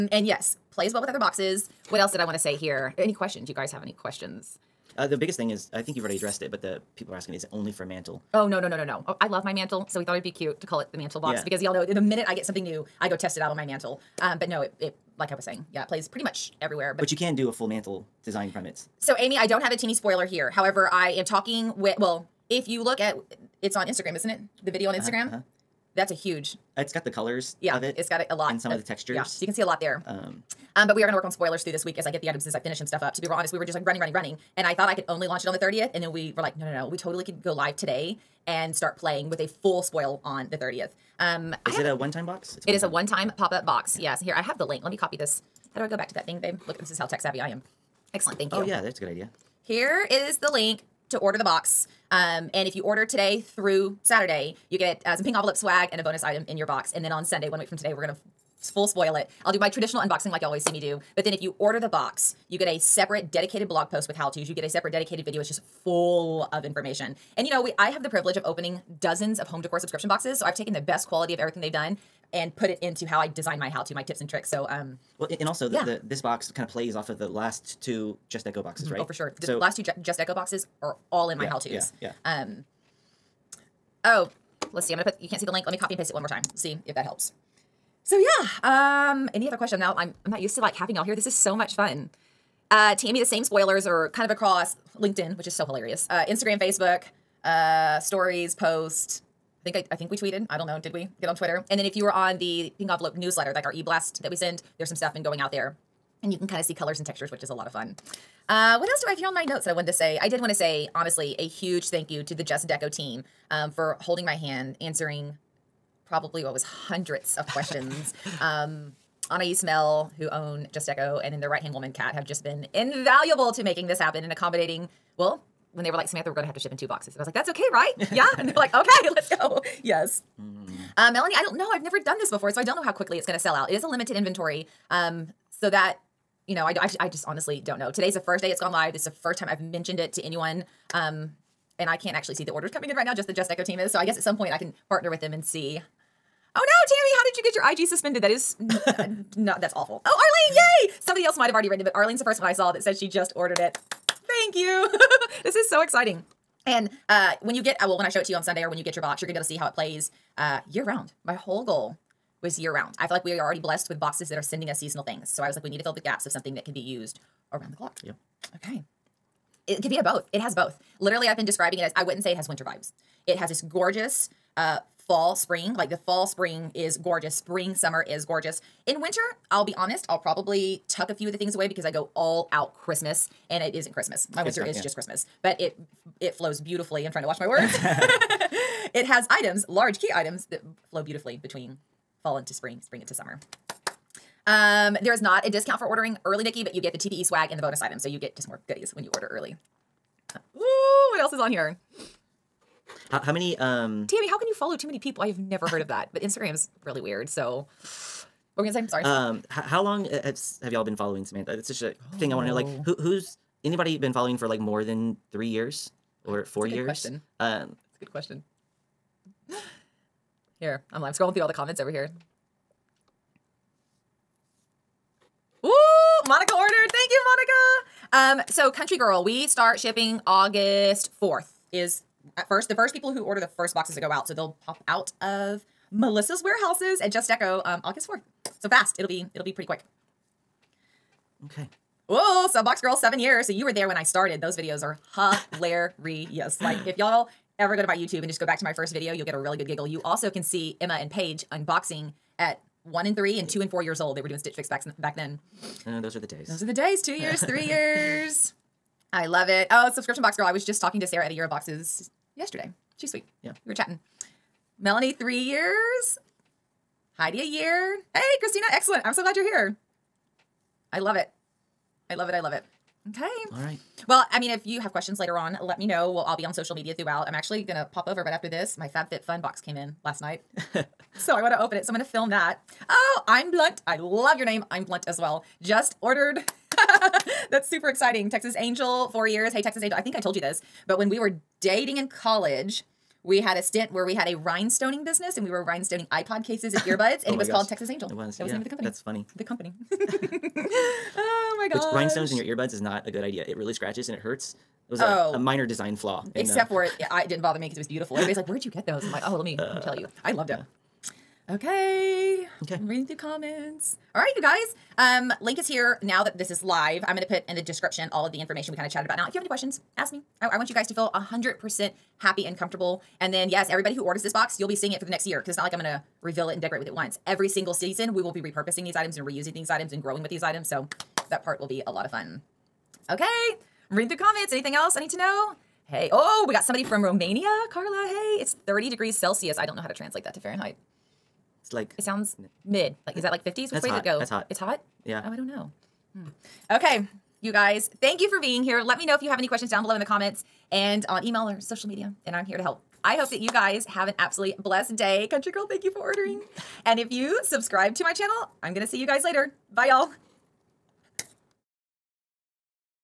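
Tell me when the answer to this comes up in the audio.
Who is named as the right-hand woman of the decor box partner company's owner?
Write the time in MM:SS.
02:01.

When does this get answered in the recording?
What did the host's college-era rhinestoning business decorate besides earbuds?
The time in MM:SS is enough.
04:56.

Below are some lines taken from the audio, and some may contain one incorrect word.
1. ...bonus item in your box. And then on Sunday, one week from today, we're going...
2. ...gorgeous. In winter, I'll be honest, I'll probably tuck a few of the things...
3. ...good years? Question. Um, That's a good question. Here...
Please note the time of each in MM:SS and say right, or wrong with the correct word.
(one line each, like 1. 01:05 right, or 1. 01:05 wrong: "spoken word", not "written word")
1. 00:56 right
2. 02:58 right
3. 03:36 right.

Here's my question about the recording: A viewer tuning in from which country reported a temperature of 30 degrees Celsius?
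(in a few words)
Romania.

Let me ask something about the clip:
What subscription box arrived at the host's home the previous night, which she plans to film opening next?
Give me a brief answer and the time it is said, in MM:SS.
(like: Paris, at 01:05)
FabFitFun, at 04:38.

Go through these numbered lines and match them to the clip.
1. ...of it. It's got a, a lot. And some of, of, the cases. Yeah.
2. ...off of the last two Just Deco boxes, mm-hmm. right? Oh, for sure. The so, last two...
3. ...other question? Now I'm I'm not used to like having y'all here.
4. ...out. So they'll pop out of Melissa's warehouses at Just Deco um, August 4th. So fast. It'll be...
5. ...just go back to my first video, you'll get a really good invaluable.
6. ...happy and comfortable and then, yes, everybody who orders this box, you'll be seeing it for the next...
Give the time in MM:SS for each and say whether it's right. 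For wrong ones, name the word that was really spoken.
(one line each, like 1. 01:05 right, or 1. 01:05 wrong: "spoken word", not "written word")
1. 00:27 wrong: "textures", not "cases"
2. 01:16 right
3. 01:29 right
4. 03:54 right
5. 04:08 wrong: "giggle", not "invaluable"
6. 05:22 right.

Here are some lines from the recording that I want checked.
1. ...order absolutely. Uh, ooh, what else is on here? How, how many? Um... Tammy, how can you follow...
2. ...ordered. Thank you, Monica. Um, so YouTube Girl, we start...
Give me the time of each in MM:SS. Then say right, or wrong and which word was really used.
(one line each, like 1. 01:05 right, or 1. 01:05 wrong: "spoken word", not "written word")
1. 03:19 wrong: "early", not "absolutely"
2. 03:46 wrong: "Country", not "YouTube".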